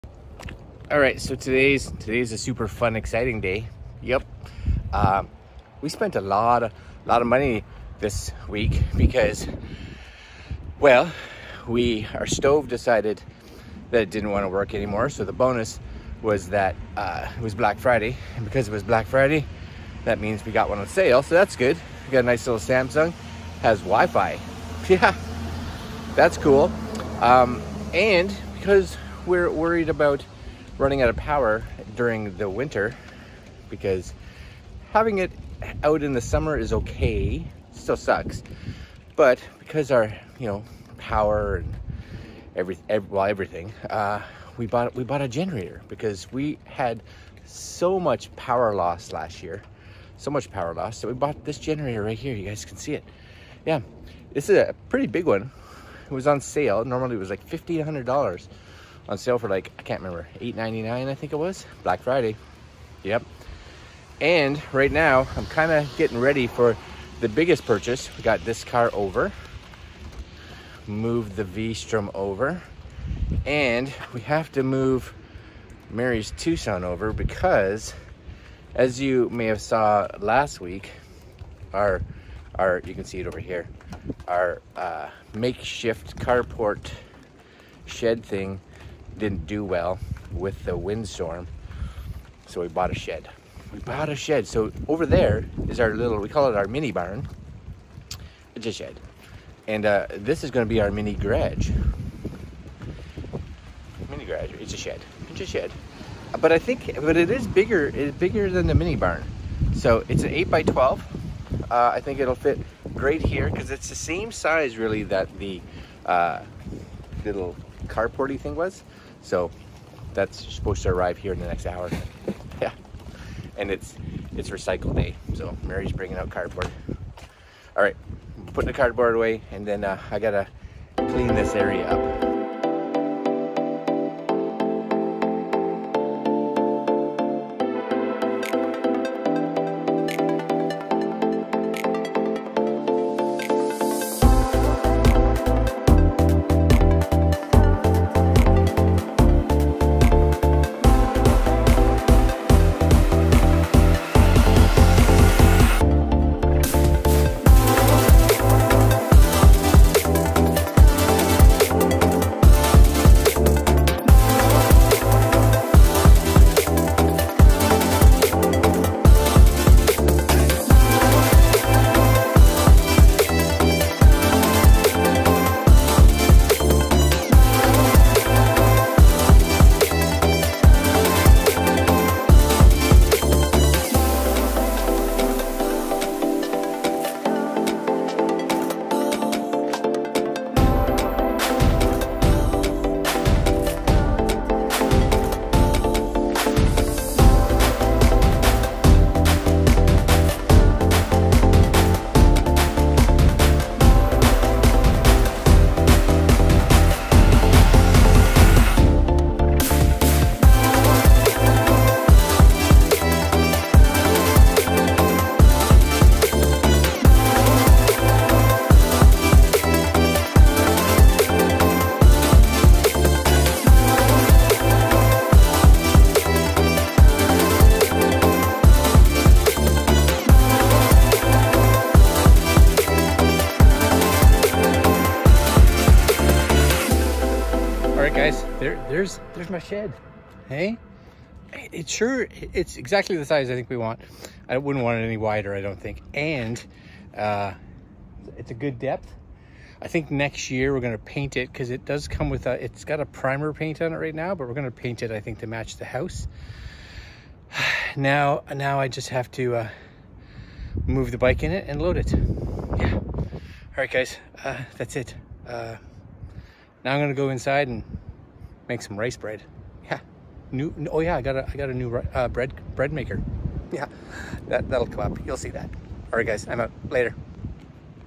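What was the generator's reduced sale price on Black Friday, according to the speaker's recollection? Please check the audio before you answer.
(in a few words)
$899.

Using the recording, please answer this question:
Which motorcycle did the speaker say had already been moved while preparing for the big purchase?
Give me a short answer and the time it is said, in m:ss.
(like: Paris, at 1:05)
V-Strom, at 1:11.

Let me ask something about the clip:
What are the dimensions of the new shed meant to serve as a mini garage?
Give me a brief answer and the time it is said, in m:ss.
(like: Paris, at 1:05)
8 by 12, at 1:50.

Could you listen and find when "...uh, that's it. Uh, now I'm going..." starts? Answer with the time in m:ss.
4:24.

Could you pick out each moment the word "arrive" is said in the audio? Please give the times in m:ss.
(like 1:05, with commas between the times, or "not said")
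2:00.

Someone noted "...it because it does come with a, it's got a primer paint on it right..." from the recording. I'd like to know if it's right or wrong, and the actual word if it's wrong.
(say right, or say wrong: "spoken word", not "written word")
right.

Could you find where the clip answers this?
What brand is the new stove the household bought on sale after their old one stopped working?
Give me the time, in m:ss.
0:22.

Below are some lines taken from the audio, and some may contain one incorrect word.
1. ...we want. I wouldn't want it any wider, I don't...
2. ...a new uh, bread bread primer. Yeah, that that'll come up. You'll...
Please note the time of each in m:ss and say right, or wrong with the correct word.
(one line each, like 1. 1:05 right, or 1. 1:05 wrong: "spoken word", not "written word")
1. 4:03 right
2. 4:31 wrong: "maker", not "primer".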